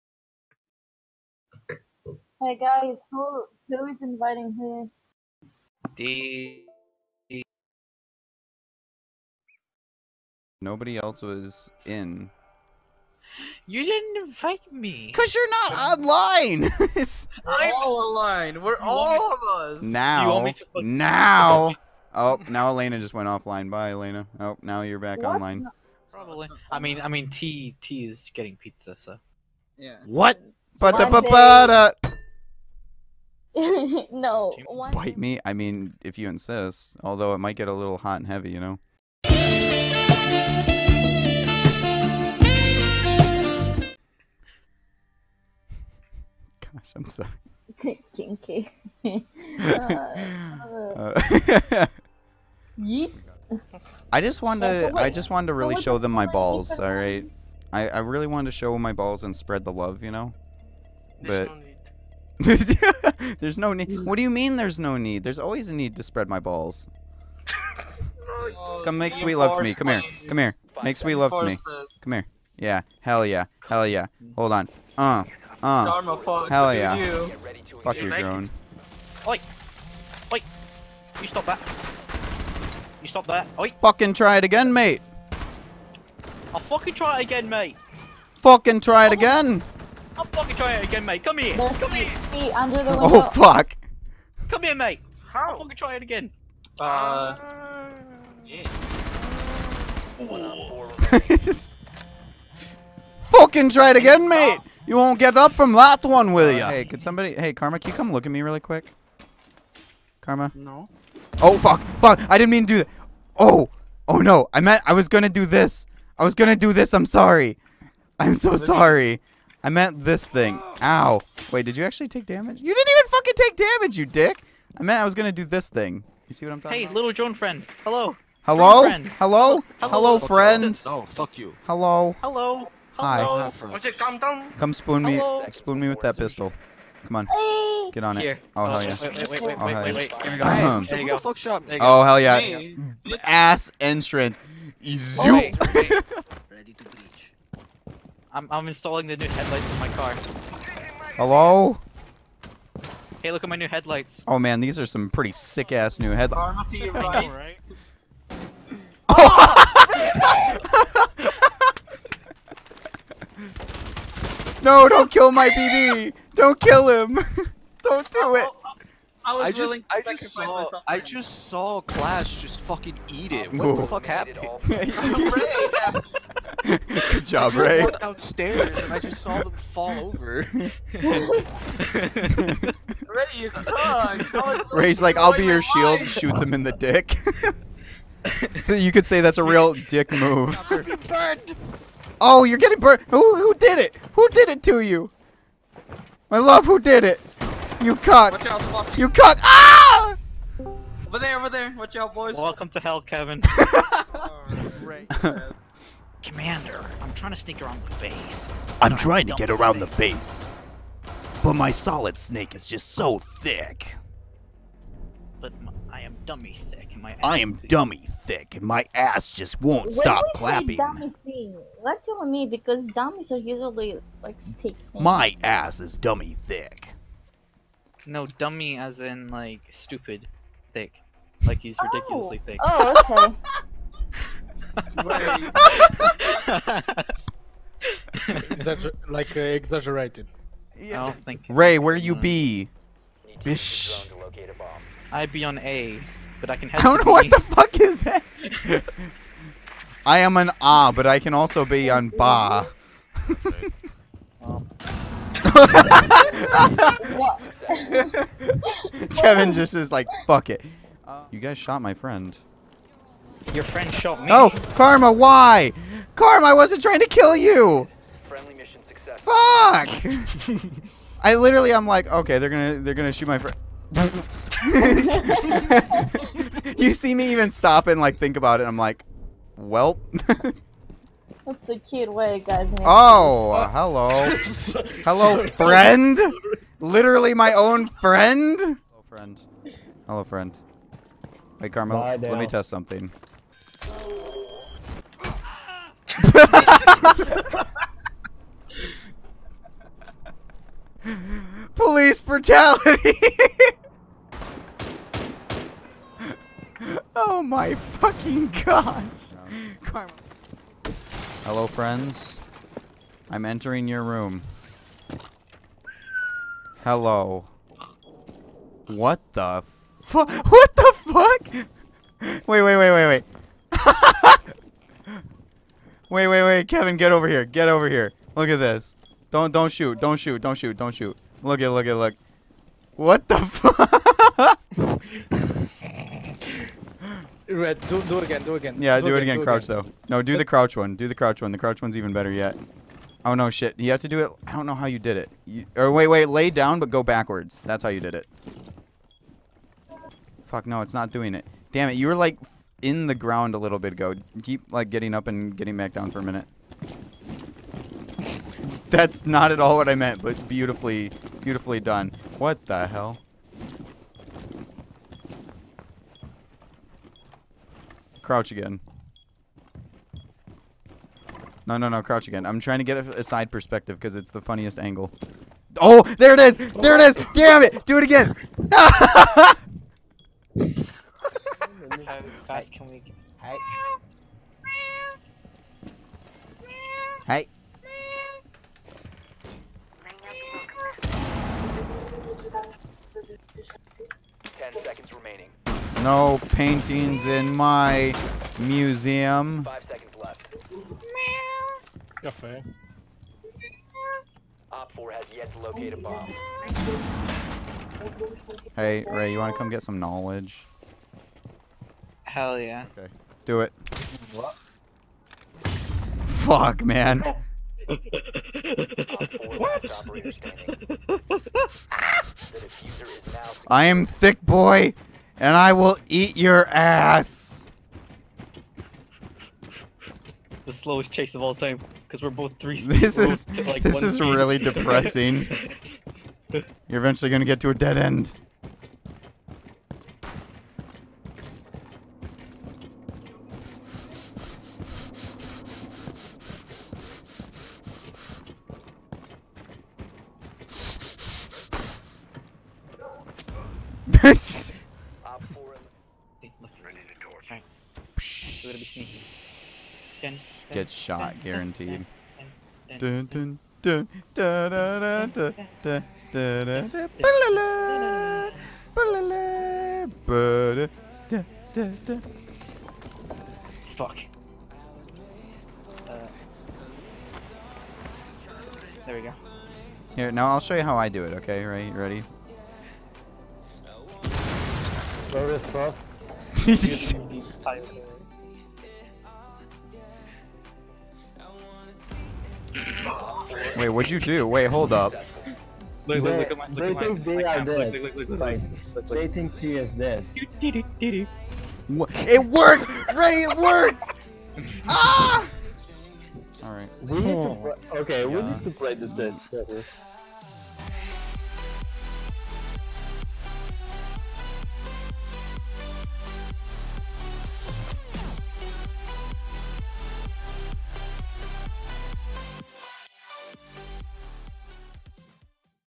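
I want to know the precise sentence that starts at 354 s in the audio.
Keep like getting up and getting back down for a minute.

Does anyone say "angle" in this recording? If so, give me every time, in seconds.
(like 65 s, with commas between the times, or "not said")
374 s.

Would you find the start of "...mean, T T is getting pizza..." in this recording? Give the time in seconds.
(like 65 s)
27 s.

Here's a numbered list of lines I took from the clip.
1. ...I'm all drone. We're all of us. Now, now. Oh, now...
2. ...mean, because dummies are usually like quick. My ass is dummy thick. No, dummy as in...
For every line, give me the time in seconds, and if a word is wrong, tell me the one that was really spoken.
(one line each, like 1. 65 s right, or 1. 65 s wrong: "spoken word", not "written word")
1. 17 s wrong: "online", not "drone"
2. 222 s wrong: "stick", not "quick".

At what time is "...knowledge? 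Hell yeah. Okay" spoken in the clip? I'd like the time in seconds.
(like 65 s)
409 s.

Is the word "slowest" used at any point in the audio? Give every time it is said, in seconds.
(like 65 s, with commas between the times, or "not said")
430 s.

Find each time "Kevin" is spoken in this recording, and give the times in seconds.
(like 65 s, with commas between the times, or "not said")
203 s, 259 s, 326 s.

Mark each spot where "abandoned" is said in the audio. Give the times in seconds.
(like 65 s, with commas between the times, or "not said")
not said.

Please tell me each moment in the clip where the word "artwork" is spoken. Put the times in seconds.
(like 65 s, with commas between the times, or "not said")
not said.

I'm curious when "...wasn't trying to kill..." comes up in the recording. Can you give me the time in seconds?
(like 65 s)
266 s.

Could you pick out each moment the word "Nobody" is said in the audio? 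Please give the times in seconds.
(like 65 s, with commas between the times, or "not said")
10 s.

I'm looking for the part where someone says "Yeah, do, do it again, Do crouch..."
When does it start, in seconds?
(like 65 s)
338 s.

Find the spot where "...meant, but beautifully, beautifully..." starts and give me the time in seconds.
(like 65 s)
359 s.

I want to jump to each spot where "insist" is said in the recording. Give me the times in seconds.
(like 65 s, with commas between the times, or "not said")
36 s.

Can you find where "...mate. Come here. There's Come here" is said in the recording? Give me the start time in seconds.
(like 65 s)
91 s.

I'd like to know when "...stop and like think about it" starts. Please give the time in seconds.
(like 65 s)
277 s.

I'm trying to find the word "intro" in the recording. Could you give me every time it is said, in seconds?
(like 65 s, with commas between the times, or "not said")
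not said.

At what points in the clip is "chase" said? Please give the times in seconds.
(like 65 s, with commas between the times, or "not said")
431 s.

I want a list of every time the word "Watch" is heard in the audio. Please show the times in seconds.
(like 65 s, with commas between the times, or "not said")
201 s.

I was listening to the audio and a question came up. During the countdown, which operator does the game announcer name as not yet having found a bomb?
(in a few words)
Op 4.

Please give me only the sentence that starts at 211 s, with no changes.
But my solid snake is just so thick.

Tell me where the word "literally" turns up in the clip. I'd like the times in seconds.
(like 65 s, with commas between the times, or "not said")
271 s, 286 s.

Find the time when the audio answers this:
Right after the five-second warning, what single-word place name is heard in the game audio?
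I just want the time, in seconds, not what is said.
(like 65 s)
402 s.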